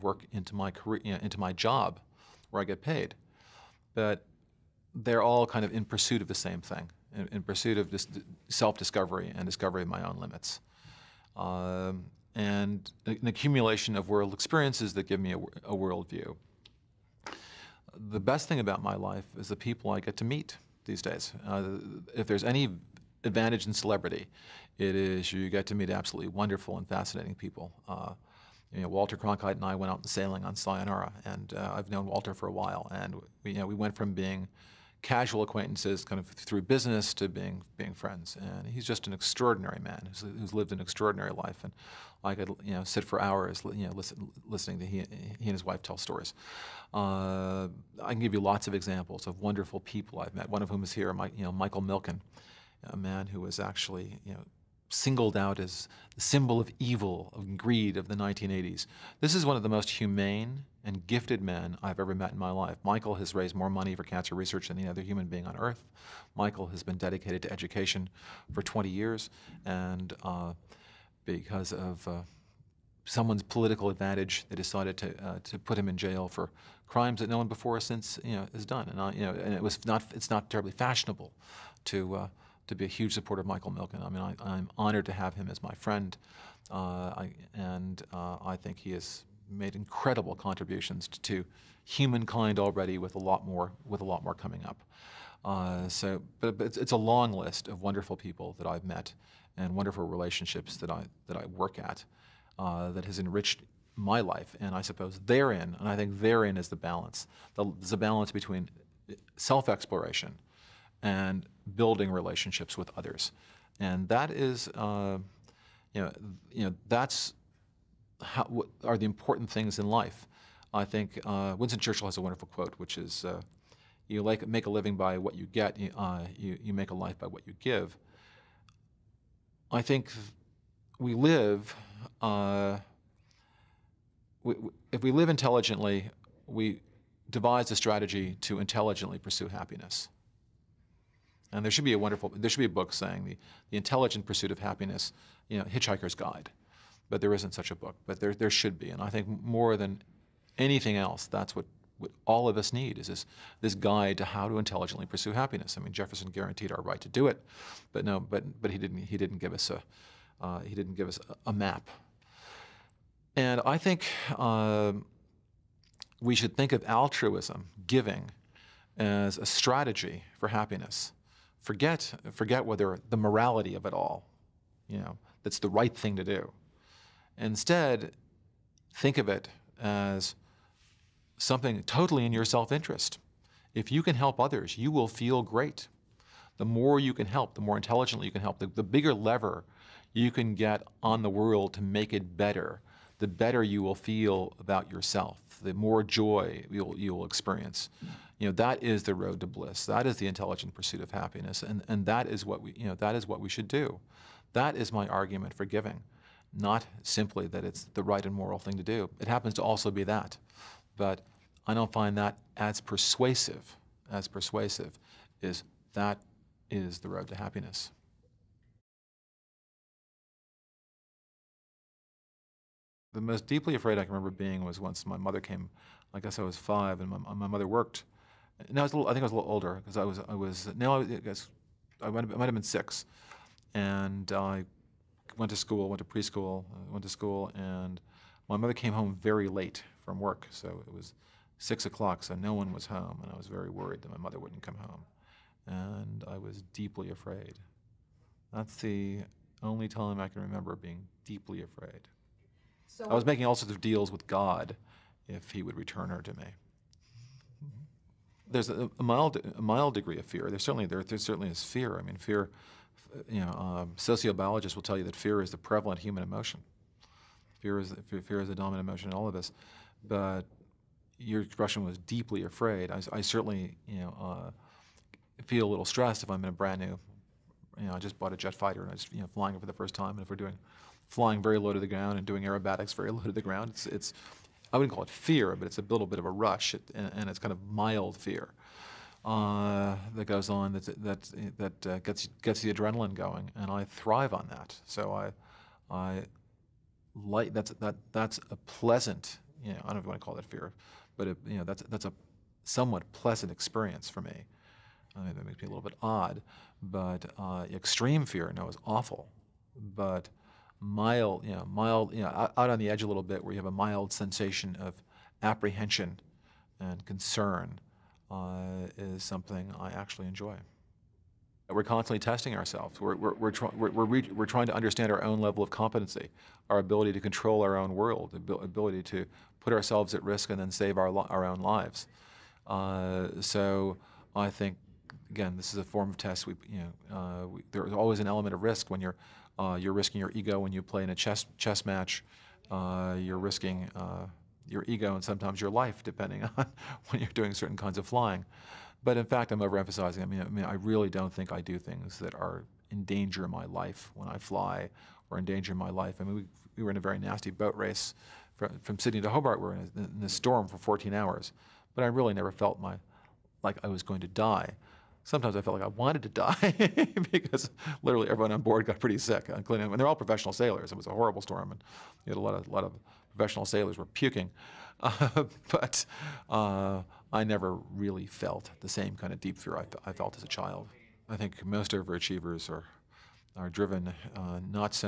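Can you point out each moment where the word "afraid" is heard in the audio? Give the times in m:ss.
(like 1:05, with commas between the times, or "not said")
3:43, 4:07, 4:11, 4:32.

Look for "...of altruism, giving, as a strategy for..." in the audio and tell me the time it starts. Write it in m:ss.
2:46.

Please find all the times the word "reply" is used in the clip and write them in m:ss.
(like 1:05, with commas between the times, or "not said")
not said.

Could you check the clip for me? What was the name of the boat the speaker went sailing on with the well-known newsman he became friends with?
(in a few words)
Sayonara.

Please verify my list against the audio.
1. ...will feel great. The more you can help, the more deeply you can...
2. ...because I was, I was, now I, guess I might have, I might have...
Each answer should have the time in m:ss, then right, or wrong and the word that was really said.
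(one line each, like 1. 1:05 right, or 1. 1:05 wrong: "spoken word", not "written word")
1. 3:04 wrong: "intelligently", not "deeply"
2. 3:49 right.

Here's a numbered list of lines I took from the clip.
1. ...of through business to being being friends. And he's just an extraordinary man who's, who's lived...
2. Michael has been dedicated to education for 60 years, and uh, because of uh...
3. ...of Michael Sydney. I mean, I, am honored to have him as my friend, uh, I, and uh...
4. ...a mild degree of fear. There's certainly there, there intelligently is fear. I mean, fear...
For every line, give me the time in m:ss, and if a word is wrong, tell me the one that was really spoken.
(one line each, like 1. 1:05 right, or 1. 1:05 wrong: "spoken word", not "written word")
1. 0:36 right
2. 1:06 wrong: "20", not "60"
3. 1:23 wrong: "Milken", not "Sydney"
4. 4:19 wrong: "certainly", not "intelligently".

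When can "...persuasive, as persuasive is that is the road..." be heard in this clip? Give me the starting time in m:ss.
3:32.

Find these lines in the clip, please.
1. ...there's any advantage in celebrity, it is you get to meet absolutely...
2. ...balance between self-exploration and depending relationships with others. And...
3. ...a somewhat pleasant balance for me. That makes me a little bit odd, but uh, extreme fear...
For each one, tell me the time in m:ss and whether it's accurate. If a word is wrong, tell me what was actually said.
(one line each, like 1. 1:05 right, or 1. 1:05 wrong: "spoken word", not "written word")
1. 0:22 right
2. 1:47 wrong: "building", not "depending"
3. 5:02 wrong: "experience", not "balance".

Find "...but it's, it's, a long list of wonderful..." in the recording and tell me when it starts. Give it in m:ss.
1:36.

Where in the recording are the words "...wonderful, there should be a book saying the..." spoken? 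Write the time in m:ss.
2:21.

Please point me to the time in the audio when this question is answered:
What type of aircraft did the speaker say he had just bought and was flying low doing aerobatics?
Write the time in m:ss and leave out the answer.
4:38.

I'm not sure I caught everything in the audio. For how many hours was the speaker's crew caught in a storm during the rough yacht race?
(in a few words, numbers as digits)
14.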